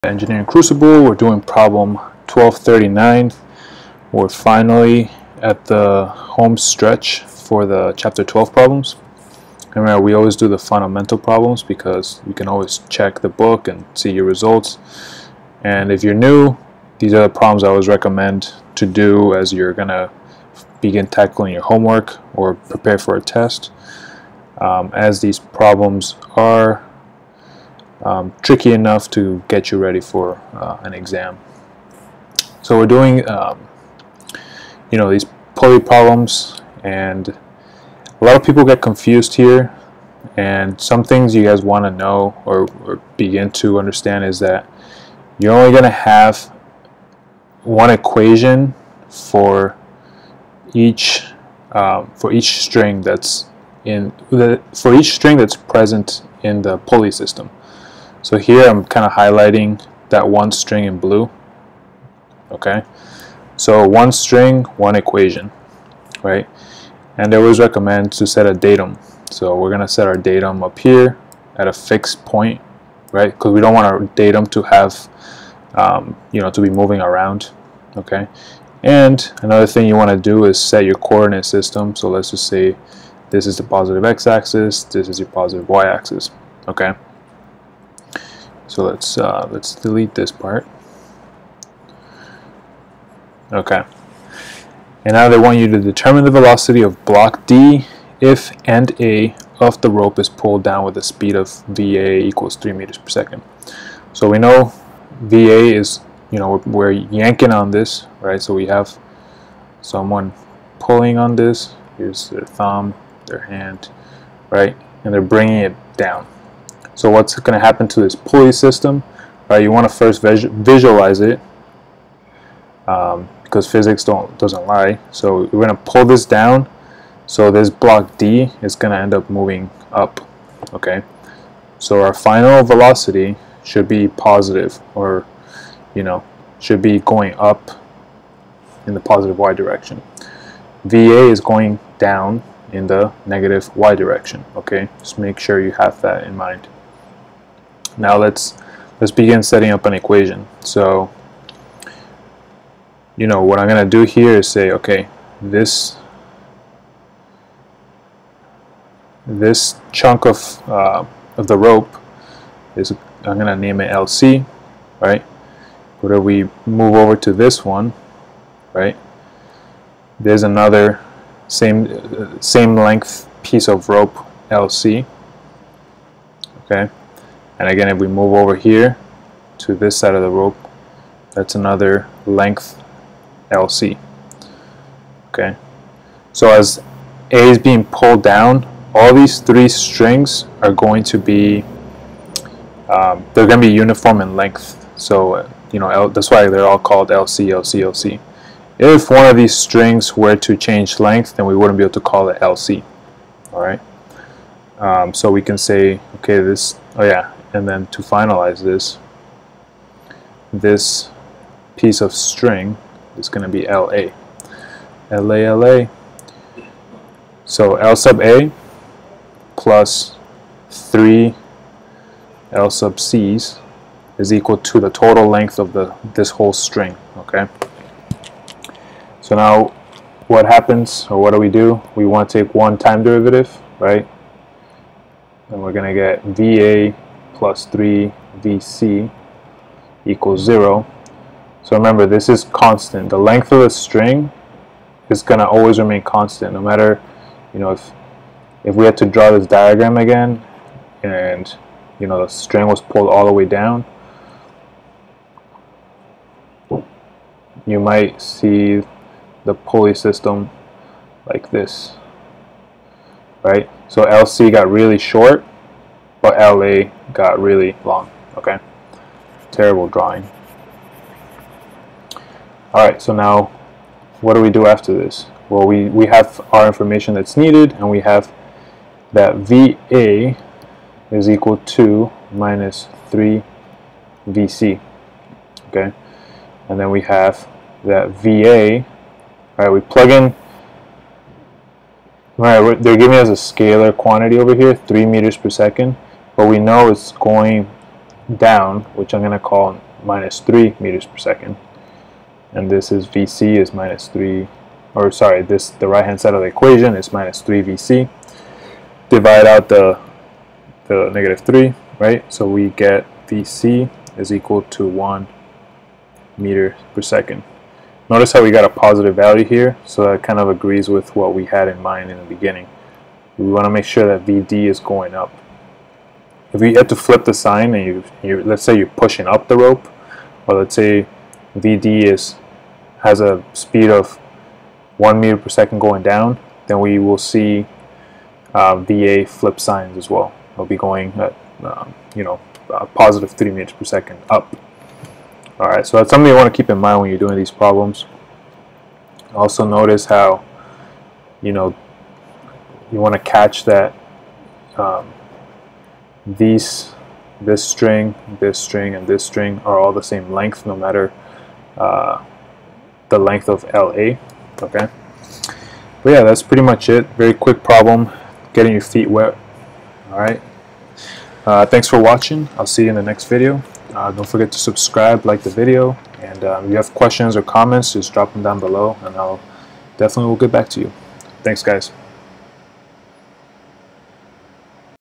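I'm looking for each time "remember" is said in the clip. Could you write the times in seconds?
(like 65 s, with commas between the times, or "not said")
9 s, 241 s.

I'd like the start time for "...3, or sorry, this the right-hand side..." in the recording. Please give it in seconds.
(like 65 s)
304 s.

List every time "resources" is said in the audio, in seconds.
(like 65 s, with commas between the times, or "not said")
not said.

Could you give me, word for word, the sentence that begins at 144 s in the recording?
Okay, just make sure you have that in mind.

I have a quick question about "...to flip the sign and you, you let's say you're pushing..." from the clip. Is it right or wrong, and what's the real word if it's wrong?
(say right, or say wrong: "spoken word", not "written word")
right.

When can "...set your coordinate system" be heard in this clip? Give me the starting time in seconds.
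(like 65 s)
80 s.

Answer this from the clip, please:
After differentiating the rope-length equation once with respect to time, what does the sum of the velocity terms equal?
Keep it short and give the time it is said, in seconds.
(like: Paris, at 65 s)
0, at 240 s.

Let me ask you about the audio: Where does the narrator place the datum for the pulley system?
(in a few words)
At a fixed point.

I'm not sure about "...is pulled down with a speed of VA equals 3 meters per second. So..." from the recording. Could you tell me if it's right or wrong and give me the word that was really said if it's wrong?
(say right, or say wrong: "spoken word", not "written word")
right.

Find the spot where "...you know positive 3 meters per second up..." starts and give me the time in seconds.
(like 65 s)
342 s.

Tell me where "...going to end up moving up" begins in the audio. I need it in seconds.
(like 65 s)
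128 s.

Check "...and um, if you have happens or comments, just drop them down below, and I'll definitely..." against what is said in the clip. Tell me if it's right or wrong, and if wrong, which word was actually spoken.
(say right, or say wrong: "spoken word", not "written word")
wrong: "questions", not "happens".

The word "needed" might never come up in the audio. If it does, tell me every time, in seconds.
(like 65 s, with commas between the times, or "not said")
277 s.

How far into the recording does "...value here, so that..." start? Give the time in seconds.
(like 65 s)
319 s.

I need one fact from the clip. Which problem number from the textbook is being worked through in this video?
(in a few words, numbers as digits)
1239.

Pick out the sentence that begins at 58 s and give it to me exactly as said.
So here I'm kind of highlighting that one string in blue.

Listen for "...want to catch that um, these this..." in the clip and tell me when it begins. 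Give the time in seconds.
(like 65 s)
352 s.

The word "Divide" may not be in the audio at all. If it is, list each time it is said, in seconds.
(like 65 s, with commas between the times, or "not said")
309 s.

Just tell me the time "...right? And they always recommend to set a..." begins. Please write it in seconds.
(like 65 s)
66 s.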